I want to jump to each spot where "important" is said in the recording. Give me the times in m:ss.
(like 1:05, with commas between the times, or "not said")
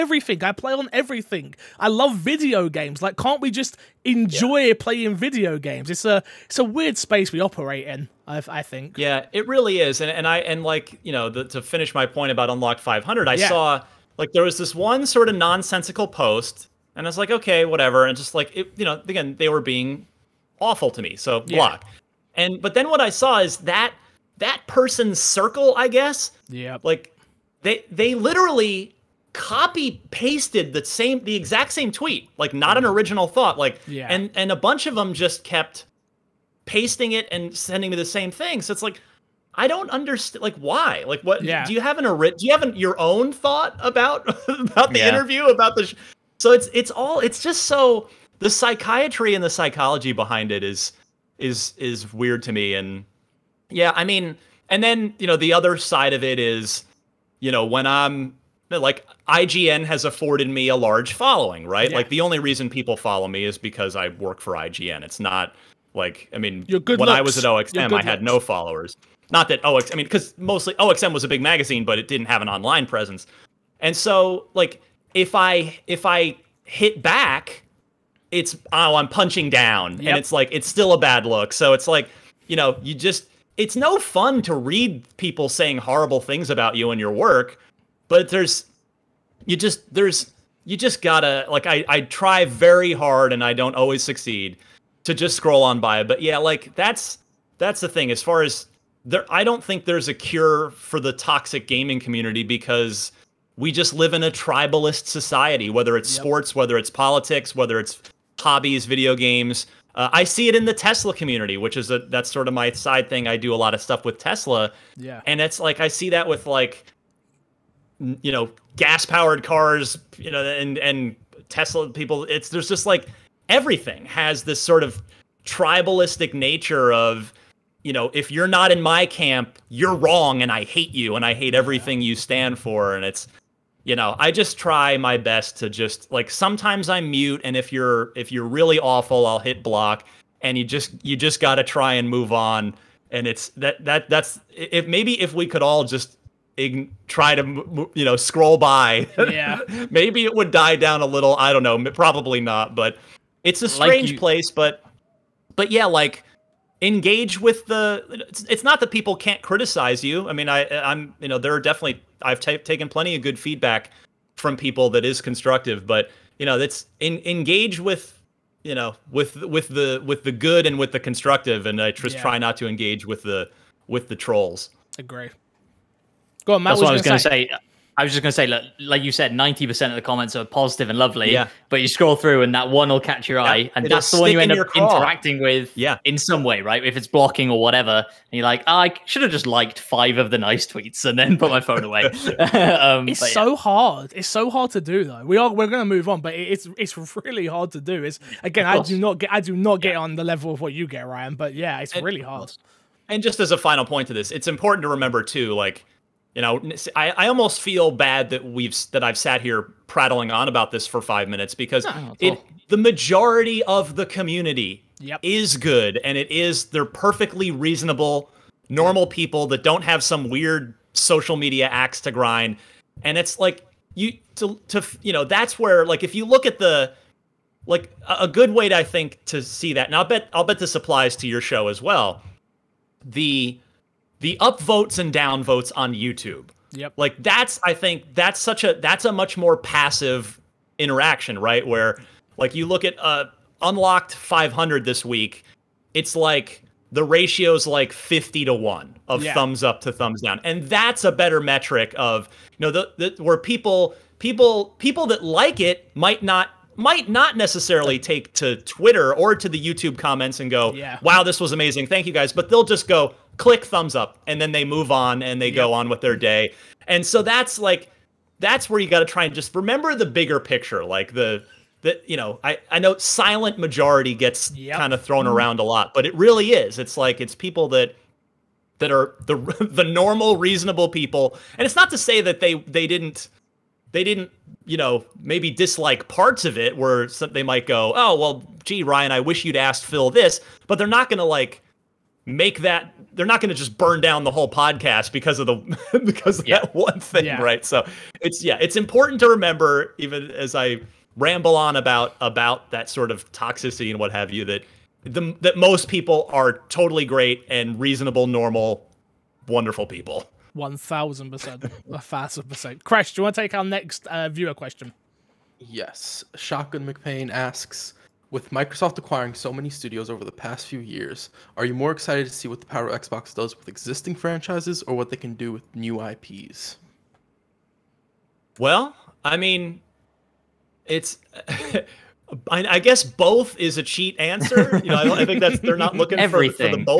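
3:24, 4:58.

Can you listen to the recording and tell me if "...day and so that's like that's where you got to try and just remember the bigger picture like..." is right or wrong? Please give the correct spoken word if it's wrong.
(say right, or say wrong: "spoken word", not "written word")
right.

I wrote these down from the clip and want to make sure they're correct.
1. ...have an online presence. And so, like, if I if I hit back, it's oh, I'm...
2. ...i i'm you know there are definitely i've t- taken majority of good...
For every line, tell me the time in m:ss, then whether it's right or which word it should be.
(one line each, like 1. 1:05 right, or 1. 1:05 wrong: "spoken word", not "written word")
1. 1:12 right
2. 2:40 wrong: "plenty", not "majority".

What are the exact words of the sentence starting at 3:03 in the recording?
and that's the one you end up interacting with yeah.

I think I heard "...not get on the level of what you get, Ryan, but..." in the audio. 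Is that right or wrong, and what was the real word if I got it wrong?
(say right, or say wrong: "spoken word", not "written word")
right.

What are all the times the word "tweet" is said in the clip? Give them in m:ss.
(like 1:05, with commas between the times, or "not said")
0:31, 3:10.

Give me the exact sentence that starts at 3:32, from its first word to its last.
the majority of the community yep.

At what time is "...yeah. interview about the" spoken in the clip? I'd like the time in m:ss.
0:44.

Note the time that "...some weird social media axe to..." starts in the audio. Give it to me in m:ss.
3:40.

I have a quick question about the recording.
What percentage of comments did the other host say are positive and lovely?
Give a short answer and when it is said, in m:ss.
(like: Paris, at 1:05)
90%, at 2:59.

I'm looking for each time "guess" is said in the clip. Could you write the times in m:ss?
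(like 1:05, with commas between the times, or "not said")
0:25, 5:32.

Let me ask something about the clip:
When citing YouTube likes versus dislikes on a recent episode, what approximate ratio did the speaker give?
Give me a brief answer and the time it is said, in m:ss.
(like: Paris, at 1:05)
50 to 1, at 4:07.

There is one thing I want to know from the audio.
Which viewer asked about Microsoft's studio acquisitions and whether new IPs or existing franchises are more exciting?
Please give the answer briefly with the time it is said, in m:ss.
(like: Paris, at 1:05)
Shotgun McPain, at 5:16.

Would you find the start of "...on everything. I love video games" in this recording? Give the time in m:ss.
0:00.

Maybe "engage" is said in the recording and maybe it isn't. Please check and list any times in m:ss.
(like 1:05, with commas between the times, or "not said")
2:36, 2:47, 2:52.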